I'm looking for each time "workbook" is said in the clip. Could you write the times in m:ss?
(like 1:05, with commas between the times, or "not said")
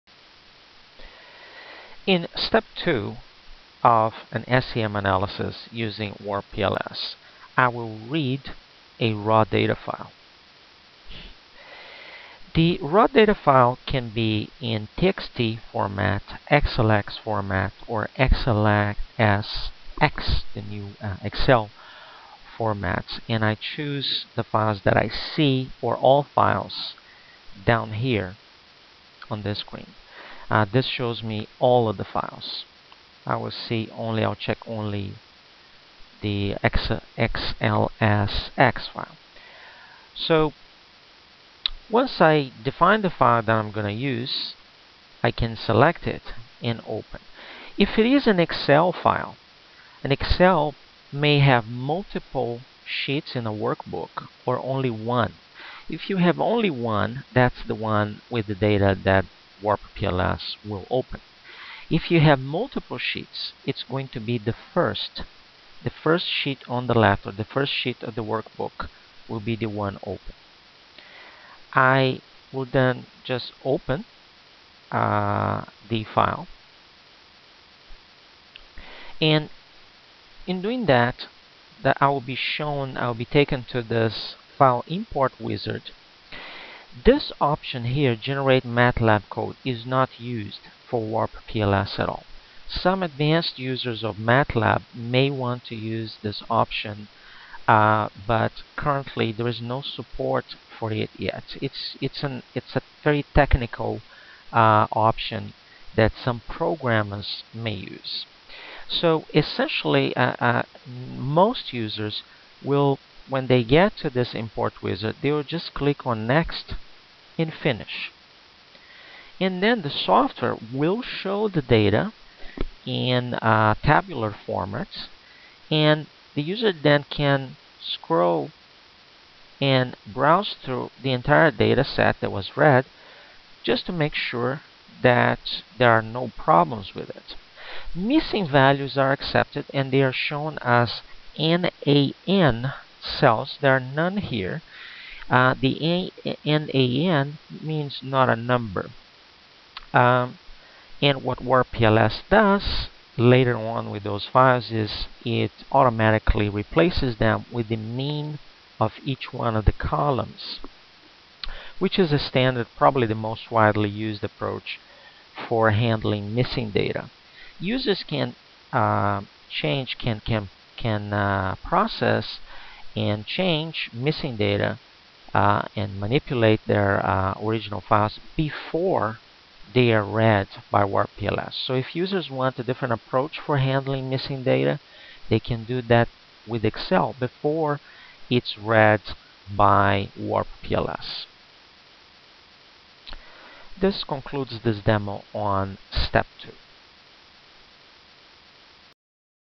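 0:53, 1:08.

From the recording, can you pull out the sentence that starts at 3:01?
So if users want a different approach for handling missing data, they can do that with Excel before it's read by PLS.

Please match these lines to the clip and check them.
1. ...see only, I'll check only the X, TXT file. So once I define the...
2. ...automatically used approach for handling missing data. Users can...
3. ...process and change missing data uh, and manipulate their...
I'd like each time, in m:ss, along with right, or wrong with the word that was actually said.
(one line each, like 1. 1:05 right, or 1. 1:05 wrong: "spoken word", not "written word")
1. 0:33 wrong: "XLSX", not "TXT"
2. 2:43 wrong: "widely", not "automatically"
3. 2:51 right.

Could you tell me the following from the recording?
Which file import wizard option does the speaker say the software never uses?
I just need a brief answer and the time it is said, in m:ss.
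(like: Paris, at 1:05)
Generate MATLAB code, at 1:28.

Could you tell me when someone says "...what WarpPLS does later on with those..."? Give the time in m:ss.
2:31.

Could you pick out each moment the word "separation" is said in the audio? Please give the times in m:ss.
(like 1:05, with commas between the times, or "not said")
not said.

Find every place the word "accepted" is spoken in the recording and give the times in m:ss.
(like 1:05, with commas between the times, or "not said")
2:19.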